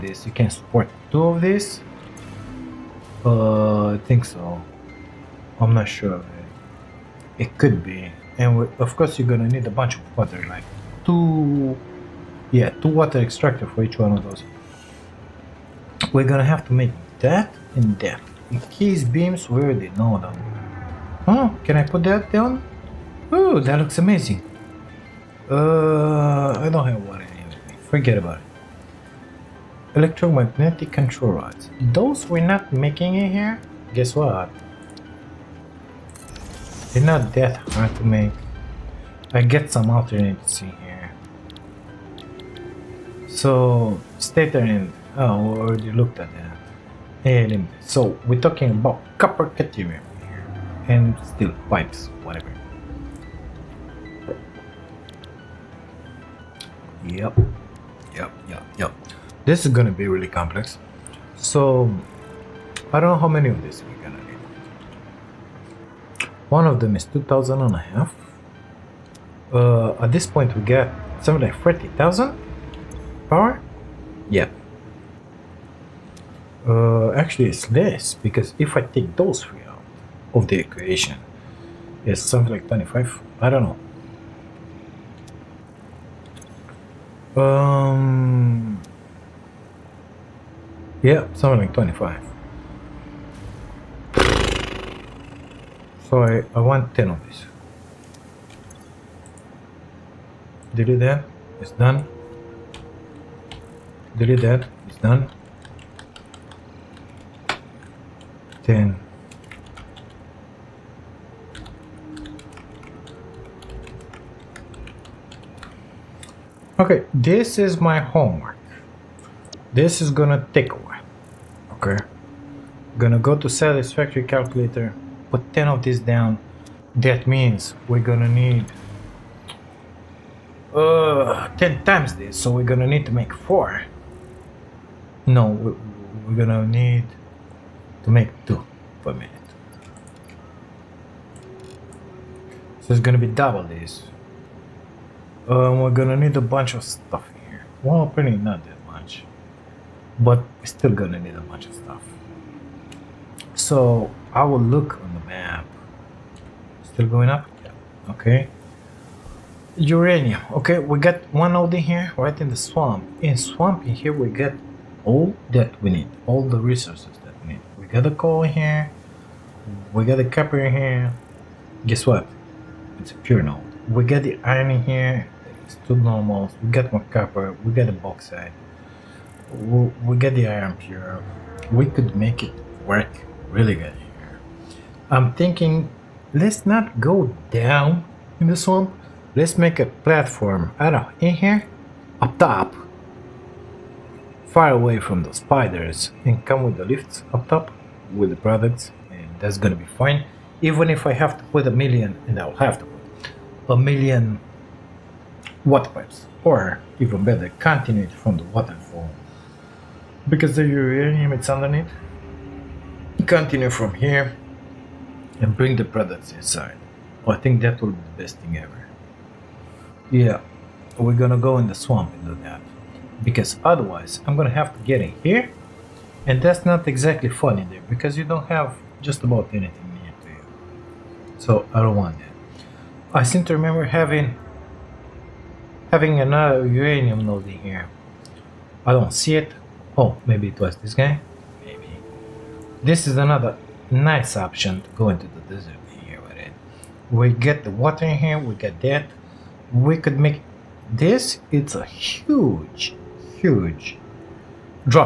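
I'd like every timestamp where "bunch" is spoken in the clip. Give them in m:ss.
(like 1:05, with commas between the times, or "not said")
0:09, 2:26, 2:31.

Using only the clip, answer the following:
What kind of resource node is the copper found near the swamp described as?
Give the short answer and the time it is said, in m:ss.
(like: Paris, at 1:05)
Pure node, at 2:52.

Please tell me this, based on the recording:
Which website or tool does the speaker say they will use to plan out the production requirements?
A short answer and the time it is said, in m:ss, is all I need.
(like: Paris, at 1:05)
Satisfactory Calculator, at 2:03.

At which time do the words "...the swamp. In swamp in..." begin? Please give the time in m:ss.
2:42.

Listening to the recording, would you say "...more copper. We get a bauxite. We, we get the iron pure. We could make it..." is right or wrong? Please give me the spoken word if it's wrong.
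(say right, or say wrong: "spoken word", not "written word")
right.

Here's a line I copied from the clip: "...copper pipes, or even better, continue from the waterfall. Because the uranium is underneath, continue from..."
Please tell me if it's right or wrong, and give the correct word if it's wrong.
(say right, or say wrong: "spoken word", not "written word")
wrong: "water", not "copper".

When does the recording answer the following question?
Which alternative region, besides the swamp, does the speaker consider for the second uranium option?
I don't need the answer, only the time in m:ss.
4:05.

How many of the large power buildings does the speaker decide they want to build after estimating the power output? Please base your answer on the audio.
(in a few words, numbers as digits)
10.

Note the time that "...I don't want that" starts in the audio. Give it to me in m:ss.
3:51.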